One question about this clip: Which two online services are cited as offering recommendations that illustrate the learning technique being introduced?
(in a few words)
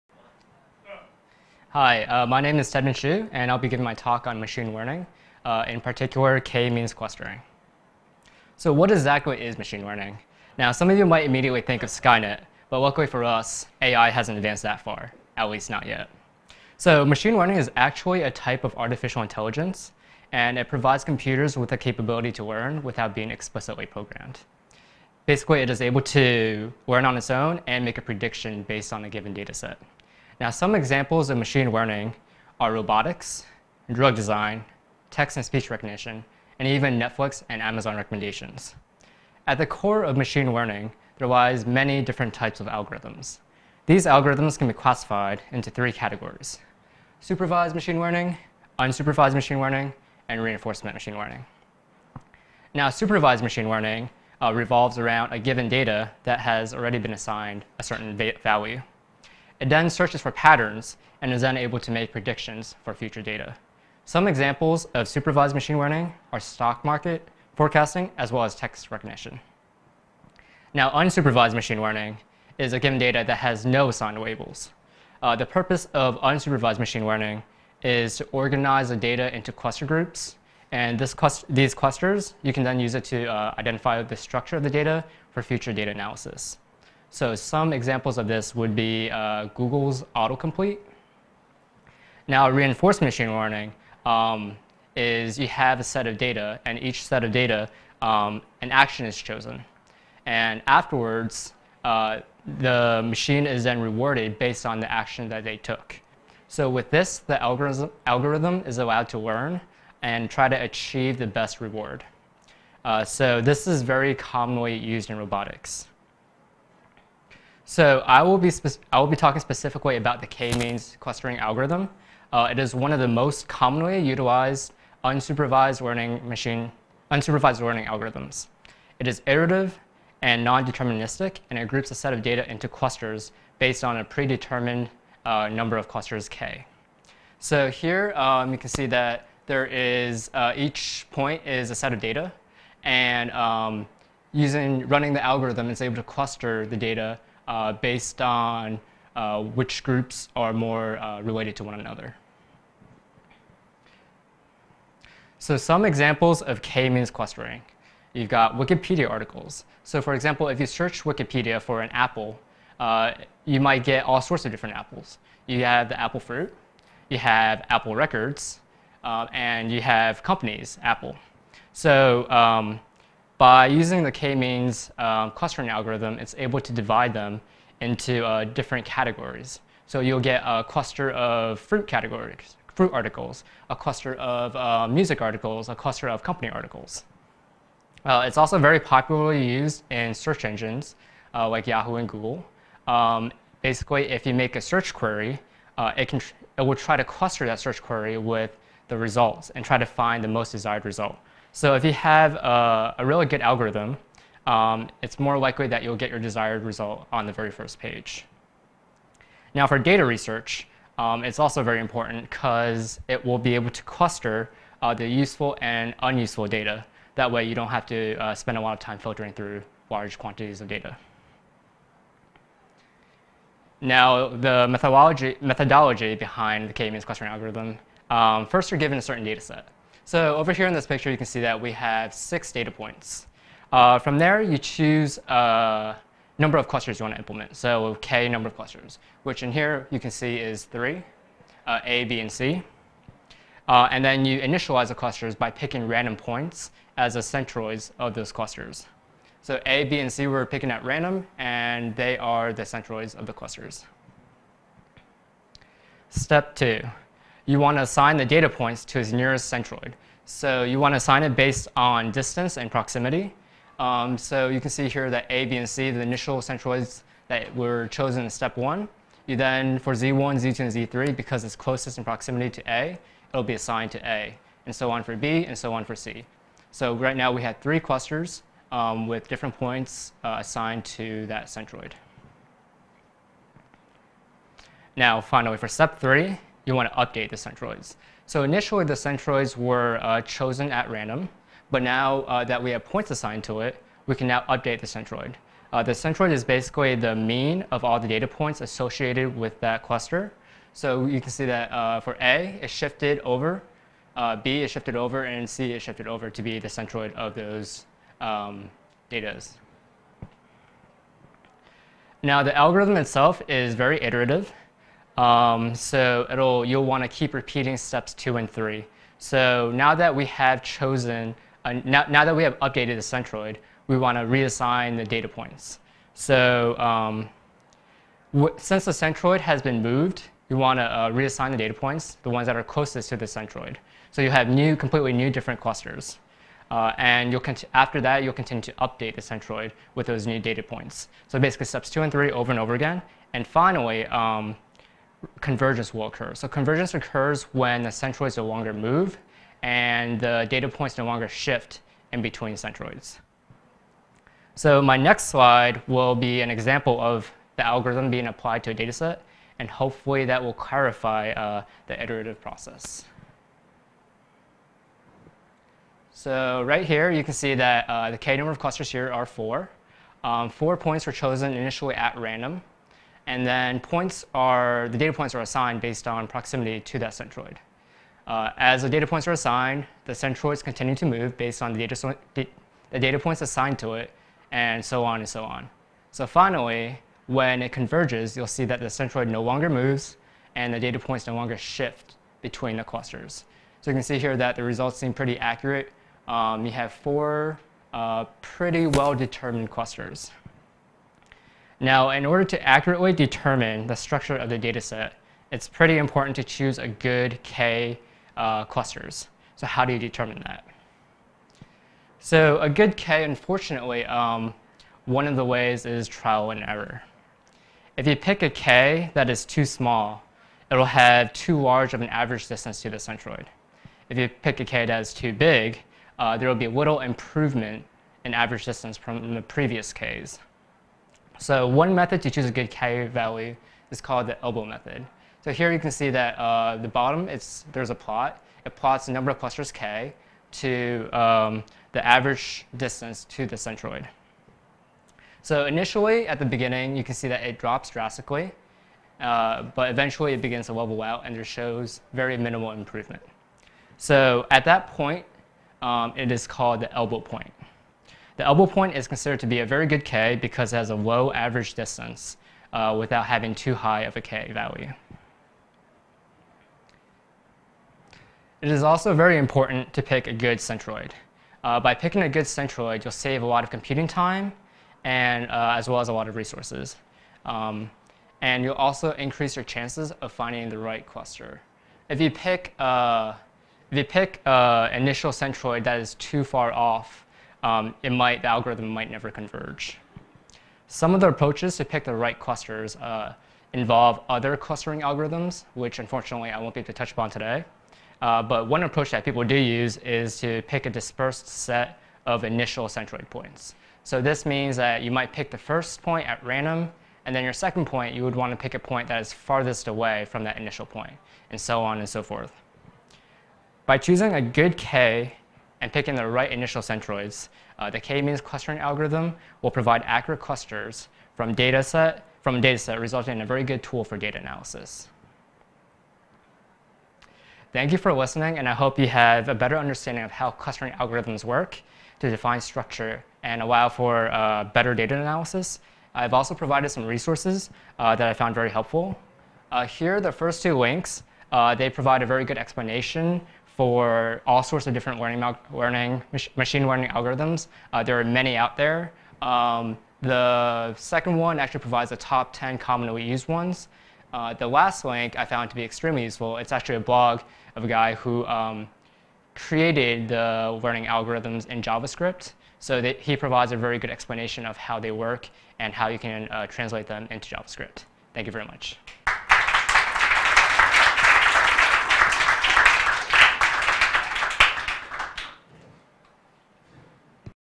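Netflix and Amazon.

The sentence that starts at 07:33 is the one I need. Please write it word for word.
So at that point, um, it is called the elbow point.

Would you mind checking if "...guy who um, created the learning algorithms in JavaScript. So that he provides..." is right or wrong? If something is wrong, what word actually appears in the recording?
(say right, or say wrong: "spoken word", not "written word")
right.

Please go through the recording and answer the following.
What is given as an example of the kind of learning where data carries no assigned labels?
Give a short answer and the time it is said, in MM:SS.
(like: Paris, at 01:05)
Google's autocomplete, at 01:29.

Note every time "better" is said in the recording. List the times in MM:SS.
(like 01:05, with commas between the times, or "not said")
08:49, 08:54.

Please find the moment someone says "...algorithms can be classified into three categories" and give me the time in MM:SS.
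00:44.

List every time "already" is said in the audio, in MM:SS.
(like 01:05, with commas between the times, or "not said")
00:56.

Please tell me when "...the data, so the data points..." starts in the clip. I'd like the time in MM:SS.
06:21.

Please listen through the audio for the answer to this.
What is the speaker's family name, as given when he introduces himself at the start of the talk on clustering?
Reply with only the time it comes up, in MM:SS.
00:02.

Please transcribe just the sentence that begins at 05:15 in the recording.
Um, so it'll, you'll want to keep repeating steps two and three.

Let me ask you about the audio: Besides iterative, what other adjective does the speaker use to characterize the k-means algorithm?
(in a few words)
non-deterministic.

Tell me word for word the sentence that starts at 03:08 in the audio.
Uh, it's also very popularly used in search engines uh, like Yahoo and Google.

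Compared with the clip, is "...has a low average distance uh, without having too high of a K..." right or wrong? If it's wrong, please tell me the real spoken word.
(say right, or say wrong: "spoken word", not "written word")
right.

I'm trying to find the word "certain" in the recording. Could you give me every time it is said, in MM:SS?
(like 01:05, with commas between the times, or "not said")
00:57, 03:49.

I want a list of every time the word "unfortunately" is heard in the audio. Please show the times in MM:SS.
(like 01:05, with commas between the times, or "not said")
06:53, 08:15.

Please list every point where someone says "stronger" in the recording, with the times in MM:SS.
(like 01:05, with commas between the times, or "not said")
not said.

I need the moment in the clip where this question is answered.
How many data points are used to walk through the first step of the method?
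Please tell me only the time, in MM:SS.
03:52.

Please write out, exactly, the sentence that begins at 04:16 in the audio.
Step two, you want to assign the data points to its nearest centroid.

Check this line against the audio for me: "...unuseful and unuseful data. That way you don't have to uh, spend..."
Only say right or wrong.
wrong.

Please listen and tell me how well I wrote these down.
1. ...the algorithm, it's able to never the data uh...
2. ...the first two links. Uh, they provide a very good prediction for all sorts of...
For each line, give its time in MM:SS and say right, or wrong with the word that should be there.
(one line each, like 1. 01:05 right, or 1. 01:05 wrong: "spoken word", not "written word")
1. 02:25 wrong: "cluster", not "never"
2. 09:00 wrong: "explanation", not "prediction".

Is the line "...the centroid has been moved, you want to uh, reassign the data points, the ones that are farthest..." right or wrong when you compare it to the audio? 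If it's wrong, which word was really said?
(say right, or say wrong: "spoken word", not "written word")
wrong: "closest", not "farthest".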